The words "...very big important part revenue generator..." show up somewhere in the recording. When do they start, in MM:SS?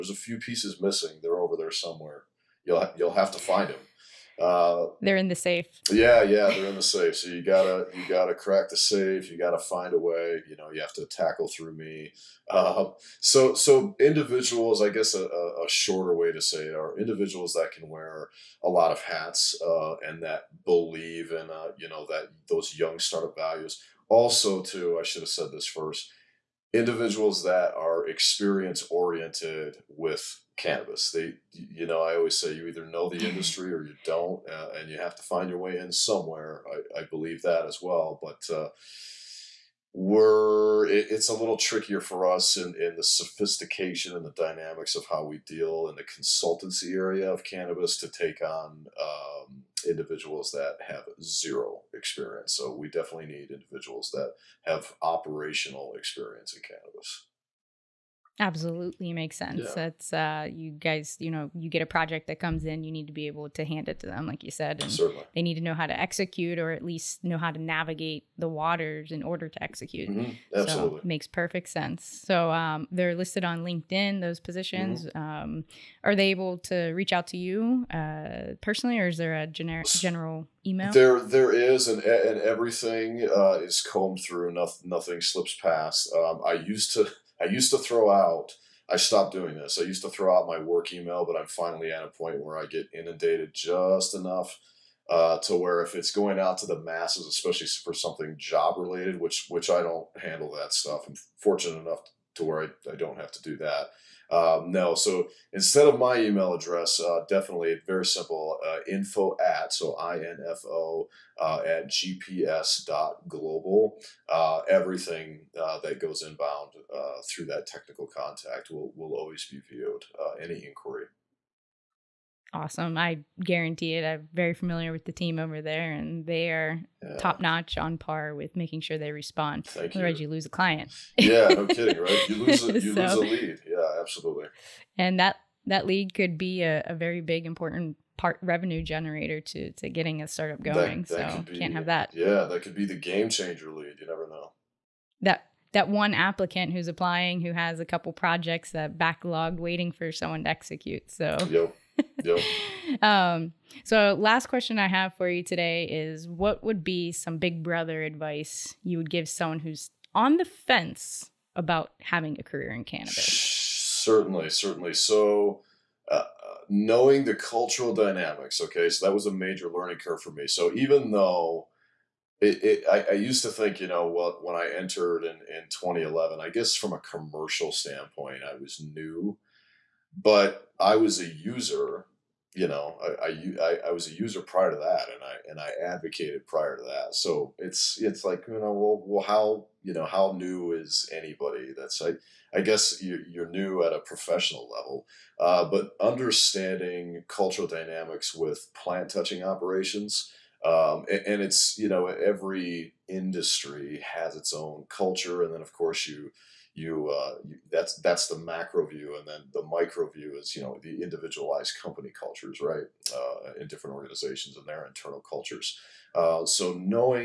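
02:16.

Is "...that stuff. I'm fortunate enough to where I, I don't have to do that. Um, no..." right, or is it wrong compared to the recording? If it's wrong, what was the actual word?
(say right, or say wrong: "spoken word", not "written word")
right.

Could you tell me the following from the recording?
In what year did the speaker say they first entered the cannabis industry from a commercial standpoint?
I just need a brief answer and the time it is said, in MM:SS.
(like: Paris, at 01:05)
2011, at 02:55.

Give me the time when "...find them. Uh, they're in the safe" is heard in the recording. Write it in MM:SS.
00:03.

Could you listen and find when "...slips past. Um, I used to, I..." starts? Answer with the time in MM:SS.
01:25.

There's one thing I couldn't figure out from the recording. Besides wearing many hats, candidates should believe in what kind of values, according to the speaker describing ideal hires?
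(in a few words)
young startup values.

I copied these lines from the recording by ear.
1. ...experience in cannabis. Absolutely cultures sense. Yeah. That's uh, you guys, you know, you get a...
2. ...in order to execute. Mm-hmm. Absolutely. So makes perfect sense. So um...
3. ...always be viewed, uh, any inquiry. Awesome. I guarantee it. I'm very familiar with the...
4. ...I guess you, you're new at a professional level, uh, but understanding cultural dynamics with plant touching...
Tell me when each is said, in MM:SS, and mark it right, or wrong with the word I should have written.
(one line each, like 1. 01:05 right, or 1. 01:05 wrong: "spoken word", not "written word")
1. 00:55 wrong: "makes", not "cultures"
2. 01:09 right
3. 01:59 right
4. 03:12 right.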